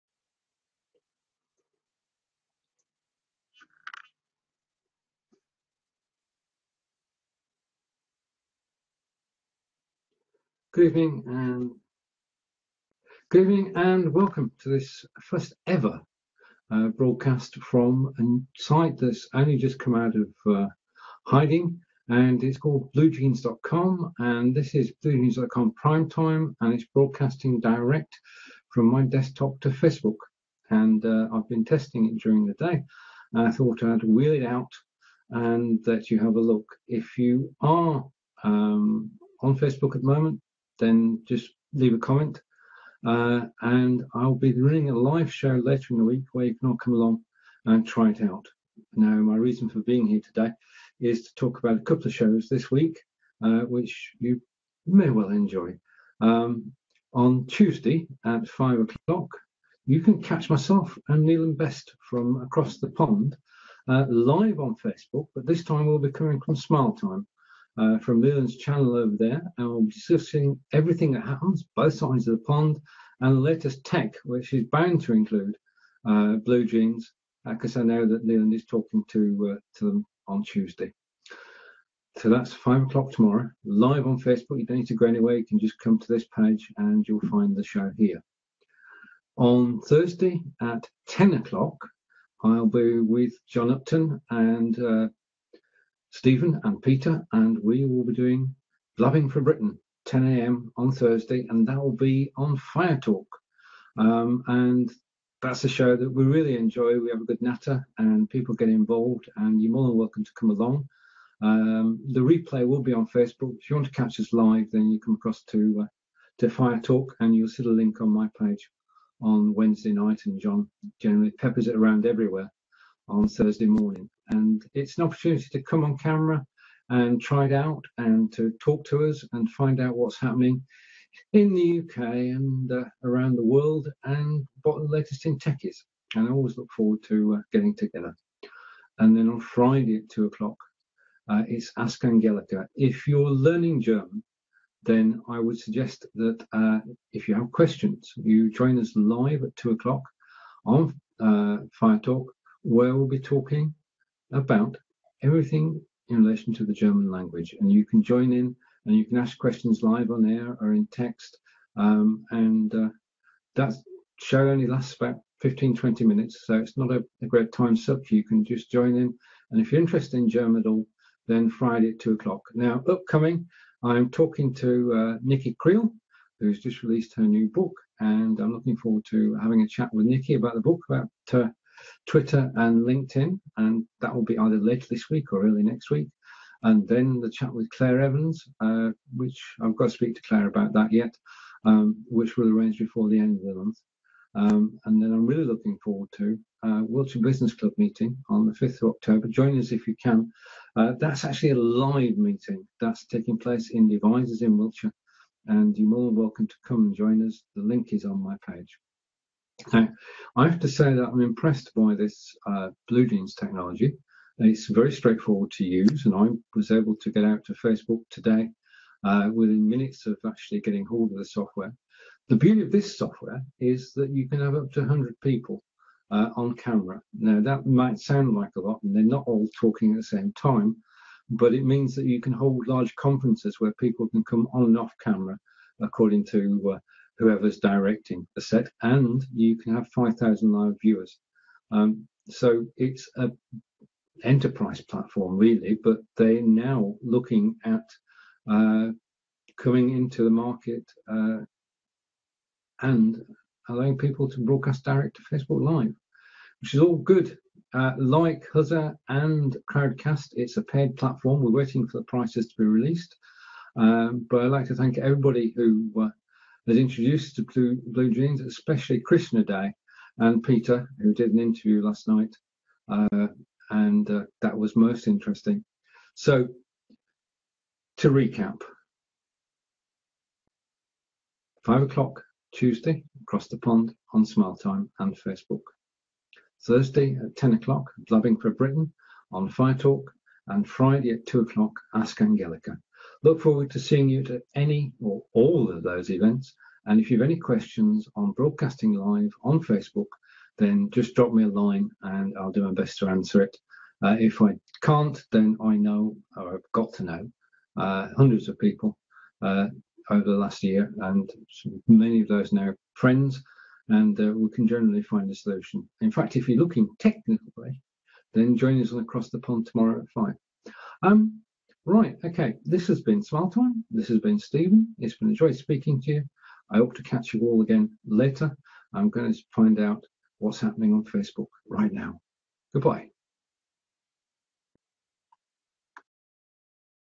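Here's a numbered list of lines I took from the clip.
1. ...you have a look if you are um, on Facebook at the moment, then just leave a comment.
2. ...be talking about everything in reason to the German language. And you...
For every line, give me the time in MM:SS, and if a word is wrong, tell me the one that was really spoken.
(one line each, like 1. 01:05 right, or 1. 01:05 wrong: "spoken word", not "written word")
1. 00:36 right
2. 02:33 wrong: "relation", not "reason".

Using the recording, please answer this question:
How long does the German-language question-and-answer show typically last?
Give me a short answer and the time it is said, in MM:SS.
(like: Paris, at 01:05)
15-20 minutes, at 02:45.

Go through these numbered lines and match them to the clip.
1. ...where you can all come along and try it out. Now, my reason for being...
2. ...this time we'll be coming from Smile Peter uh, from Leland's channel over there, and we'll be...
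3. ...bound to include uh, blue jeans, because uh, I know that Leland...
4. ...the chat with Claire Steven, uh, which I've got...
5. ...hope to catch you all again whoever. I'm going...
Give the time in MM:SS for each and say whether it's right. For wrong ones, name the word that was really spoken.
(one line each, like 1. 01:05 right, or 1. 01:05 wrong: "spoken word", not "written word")
1. 00:46 right
2. 01:05 wrong: "Time", not "Peter"
3. 01:14 right
4. 03:07 wrong: "Evans", not "Steven"
5. 05:26 wrong: "later", not "whoever".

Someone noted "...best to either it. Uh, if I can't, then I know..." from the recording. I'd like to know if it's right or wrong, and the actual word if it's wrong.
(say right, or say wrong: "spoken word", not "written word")
wrong: "answer", not "either".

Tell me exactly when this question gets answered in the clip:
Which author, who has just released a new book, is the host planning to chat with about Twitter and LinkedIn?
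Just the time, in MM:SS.
02:55.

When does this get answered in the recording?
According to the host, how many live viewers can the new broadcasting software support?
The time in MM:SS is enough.
03:59.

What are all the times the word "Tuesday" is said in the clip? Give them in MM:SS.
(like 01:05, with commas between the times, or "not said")
00:57, 01:20, 04:42.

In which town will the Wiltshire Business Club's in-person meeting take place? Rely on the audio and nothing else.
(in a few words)
Devizes.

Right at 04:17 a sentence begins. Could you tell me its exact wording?
Uh, like Huzza and Crowdcast, it's a paid platform.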